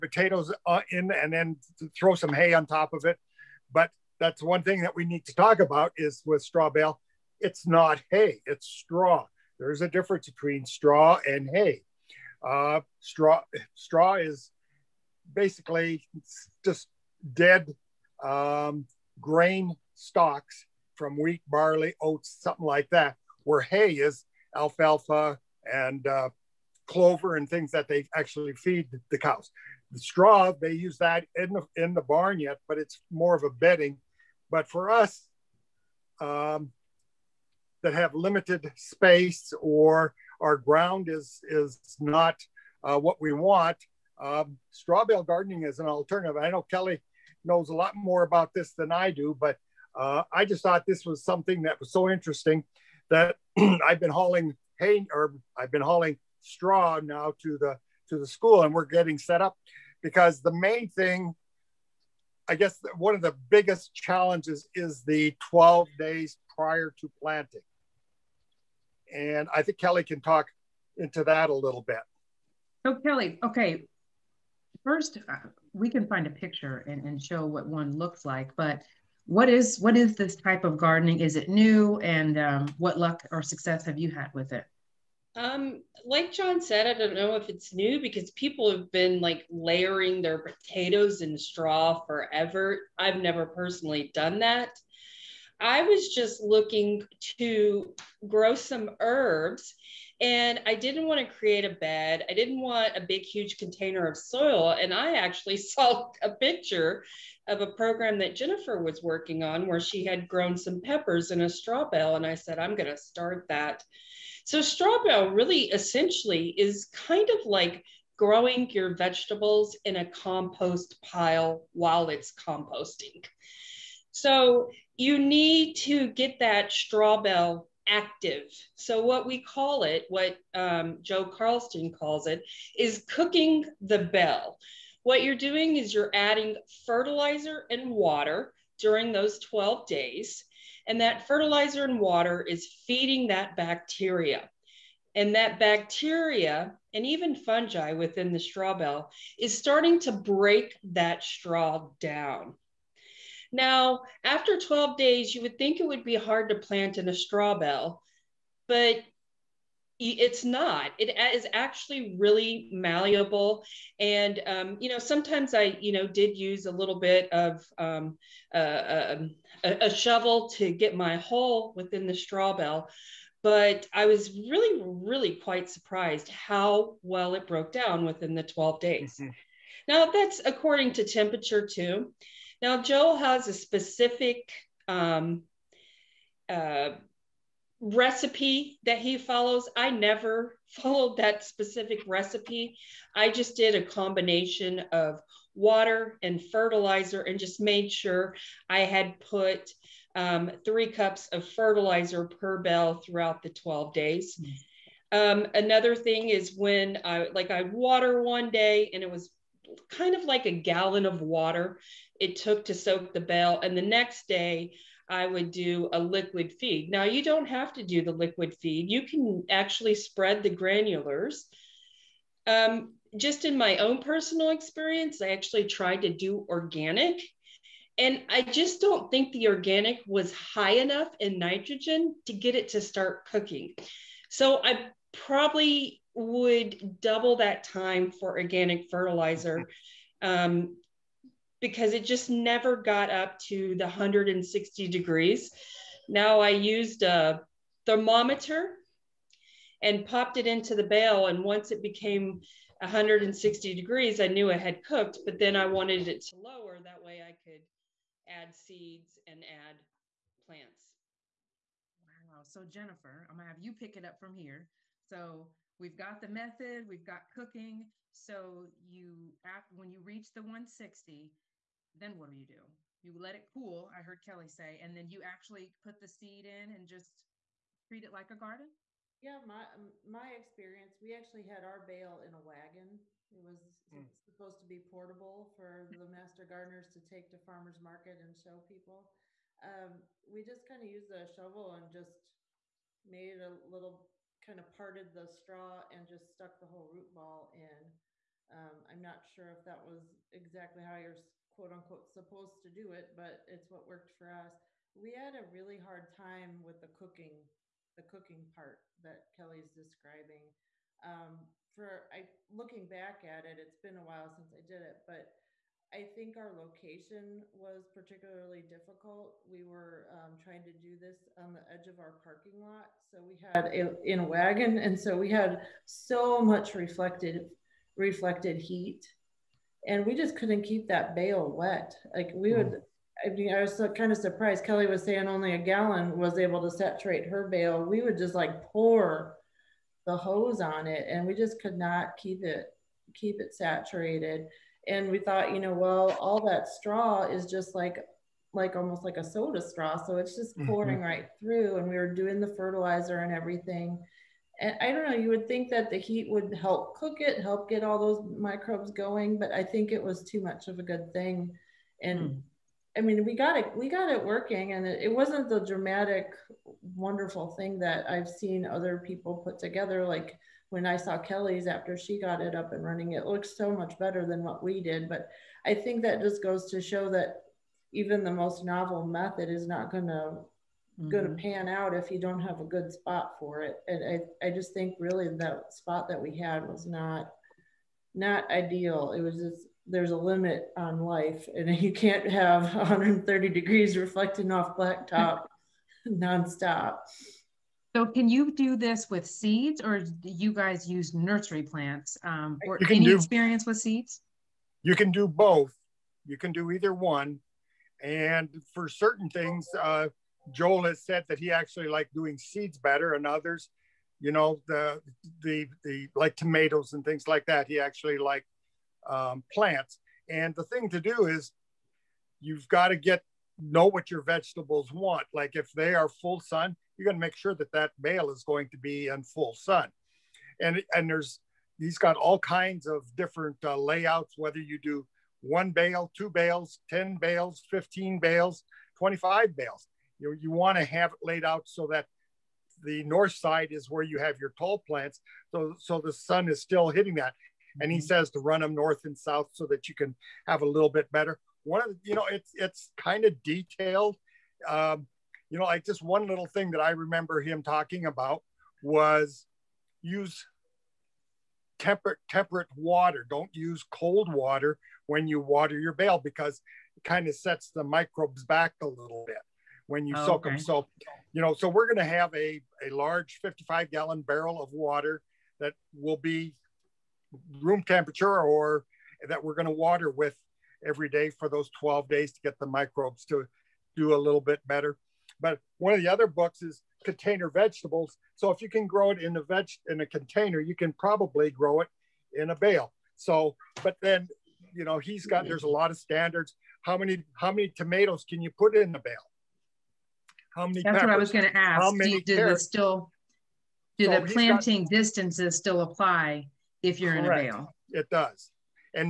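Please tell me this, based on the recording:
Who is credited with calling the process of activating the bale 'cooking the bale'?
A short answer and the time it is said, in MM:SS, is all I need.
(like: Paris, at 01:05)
Joe Karsten, at 02:11.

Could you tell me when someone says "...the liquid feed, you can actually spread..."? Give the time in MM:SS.
03:38.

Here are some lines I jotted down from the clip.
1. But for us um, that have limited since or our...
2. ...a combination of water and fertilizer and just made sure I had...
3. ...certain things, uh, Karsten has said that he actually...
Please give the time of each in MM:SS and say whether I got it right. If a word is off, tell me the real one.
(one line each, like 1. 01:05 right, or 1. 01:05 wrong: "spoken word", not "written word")
1. 00:34 wrong: "space", not "since"
2. 03:13 right
3. 06:48 wrong: "Joel", not "Karsten".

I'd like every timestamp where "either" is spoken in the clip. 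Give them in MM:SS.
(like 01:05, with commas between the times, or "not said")
06:46.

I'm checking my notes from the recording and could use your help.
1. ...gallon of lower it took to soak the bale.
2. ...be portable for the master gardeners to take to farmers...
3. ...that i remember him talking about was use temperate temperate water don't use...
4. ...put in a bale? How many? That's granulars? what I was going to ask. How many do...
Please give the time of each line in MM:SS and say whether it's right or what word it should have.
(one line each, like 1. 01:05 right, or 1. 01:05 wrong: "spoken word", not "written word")
1. 03:30 wrong: "water", not "lower"
2. 04:44 right
3. 07:36 right
4. 08:18 wrong: "peppers", not "granulars".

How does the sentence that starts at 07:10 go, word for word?
And and there's he's got all kinds of different uh, layouts.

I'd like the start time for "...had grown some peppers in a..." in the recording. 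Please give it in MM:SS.
01:50.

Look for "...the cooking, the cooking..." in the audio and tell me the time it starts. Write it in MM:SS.
05:06.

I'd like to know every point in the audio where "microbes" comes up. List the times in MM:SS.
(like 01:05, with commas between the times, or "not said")
05:58, 07:47, 08:02.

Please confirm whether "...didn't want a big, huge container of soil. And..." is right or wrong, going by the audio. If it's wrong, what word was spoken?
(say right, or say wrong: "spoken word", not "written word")
right.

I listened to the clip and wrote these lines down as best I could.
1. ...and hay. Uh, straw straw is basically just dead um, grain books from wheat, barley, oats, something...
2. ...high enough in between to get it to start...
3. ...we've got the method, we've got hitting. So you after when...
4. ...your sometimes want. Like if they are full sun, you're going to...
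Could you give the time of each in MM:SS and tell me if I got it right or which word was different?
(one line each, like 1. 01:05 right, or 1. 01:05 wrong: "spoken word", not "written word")
1. 00:11 wrong: "stalks", not "books"
2. 03:50 wrong: "nitrogen", not "between"
3. 04:25 wrong: "cooking", not "hitting"
4. 07:04 wrong: "vegetables", not "sometimes".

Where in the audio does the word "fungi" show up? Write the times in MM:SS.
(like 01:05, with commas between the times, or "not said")
02:27.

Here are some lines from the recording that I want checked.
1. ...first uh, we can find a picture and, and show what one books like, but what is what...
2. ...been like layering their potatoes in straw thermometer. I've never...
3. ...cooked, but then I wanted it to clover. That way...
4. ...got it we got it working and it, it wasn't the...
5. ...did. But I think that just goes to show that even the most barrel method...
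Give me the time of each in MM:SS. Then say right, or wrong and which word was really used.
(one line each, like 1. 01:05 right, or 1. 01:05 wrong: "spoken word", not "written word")
1. 01:14 wrong: "looks", not "books"
2. 01:28 wrong: "forever", not "thermometer"
3. 04:14 wrong: "lower", not "clover"
4. 06:03 right
5. 06:14 wrong: "novel", not "barrel".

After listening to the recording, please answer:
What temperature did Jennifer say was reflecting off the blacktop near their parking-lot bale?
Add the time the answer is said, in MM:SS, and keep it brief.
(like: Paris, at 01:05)
130 degrees, at 06:32.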